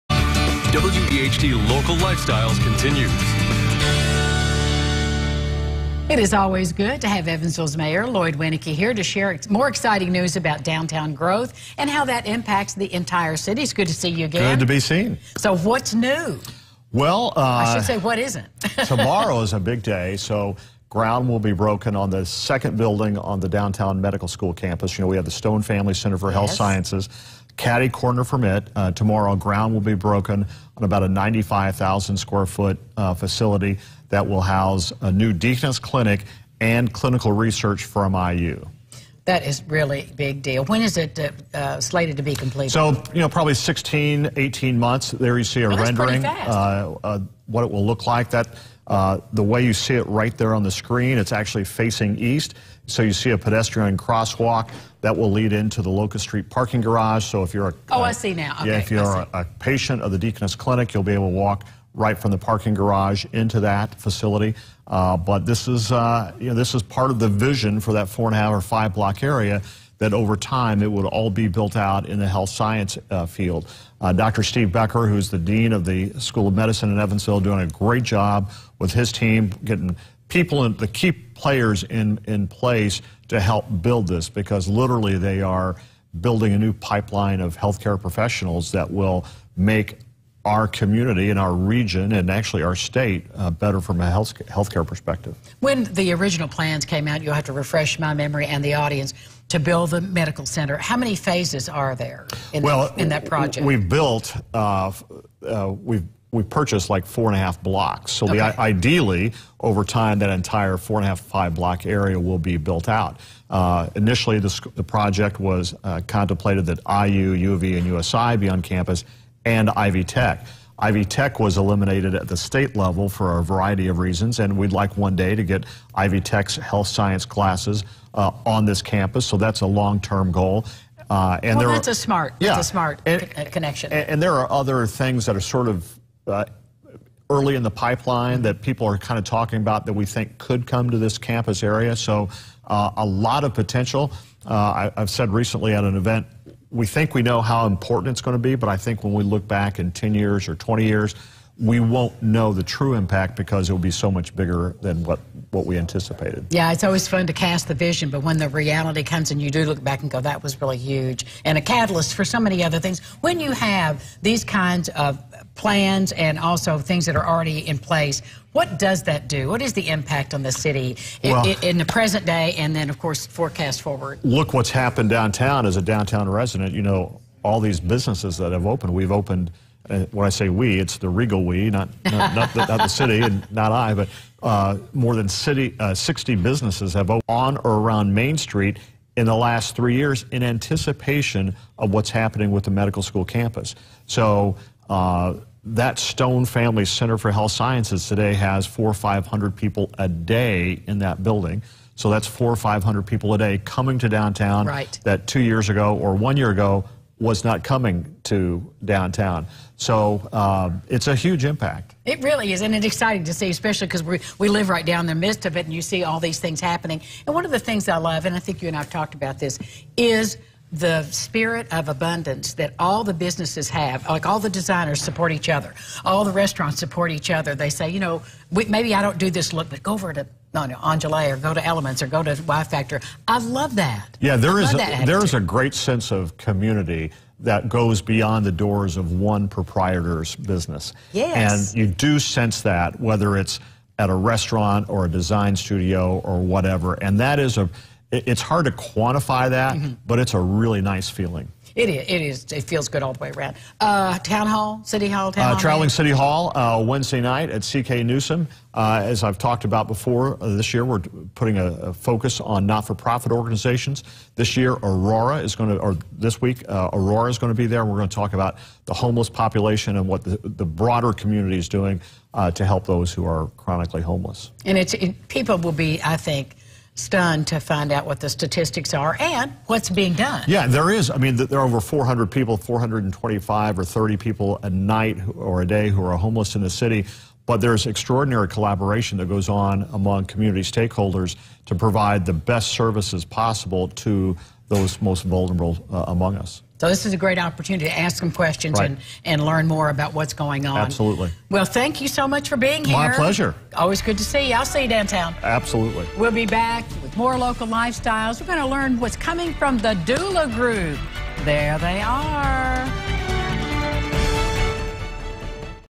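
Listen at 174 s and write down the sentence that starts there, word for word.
Look what's happened downtown as a downtown resident.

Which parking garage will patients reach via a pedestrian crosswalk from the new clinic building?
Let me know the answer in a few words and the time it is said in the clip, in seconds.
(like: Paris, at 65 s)
Locust Street, at 55 s.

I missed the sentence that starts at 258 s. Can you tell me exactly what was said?
Uh, as I've talked about before, uh, this year we're putting a, a focus on not-for-profit organizations.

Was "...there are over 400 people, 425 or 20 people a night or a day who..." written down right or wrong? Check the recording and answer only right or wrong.
wrong.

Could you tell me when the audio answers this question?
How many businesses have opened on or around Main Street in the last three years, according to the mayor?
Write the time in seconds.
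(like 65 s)
185 s.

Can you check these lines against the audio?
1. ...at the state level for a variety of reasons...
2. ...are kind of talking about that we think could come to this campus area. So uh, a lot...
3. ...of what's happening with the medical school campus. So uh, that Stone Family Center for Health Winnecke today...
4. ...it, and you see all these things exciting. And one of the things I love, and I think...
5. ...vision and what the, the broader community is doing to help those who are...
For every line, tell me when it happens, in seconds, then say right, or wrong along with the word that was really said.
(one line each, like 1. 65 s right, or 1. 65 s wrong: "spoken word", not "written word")
1. 122 s right
2. 138 s right
3. 191 s wrong: "Sciences", not "Winnecke"
4. 215 s wrong: "happening", not "exciting"
5. 269 s wrong: "population", not "vision".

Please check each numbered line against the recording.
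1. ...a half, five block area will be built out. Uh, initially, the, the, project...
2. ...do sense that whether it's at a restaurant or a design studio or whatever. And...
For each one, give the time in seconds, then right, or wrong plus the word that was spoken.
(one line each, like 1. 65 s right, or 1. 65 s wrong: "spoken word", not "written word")
1. 111 s right
2. 241 s right.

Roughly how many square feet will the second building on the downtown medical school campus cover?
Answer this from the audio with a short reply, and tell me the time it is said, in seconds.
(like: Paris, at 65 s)
95,000, at 31 s.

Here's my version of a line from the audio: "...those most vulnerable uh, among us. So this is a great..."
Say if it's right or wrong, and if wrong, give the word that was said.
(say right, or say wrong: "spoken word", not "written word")
right.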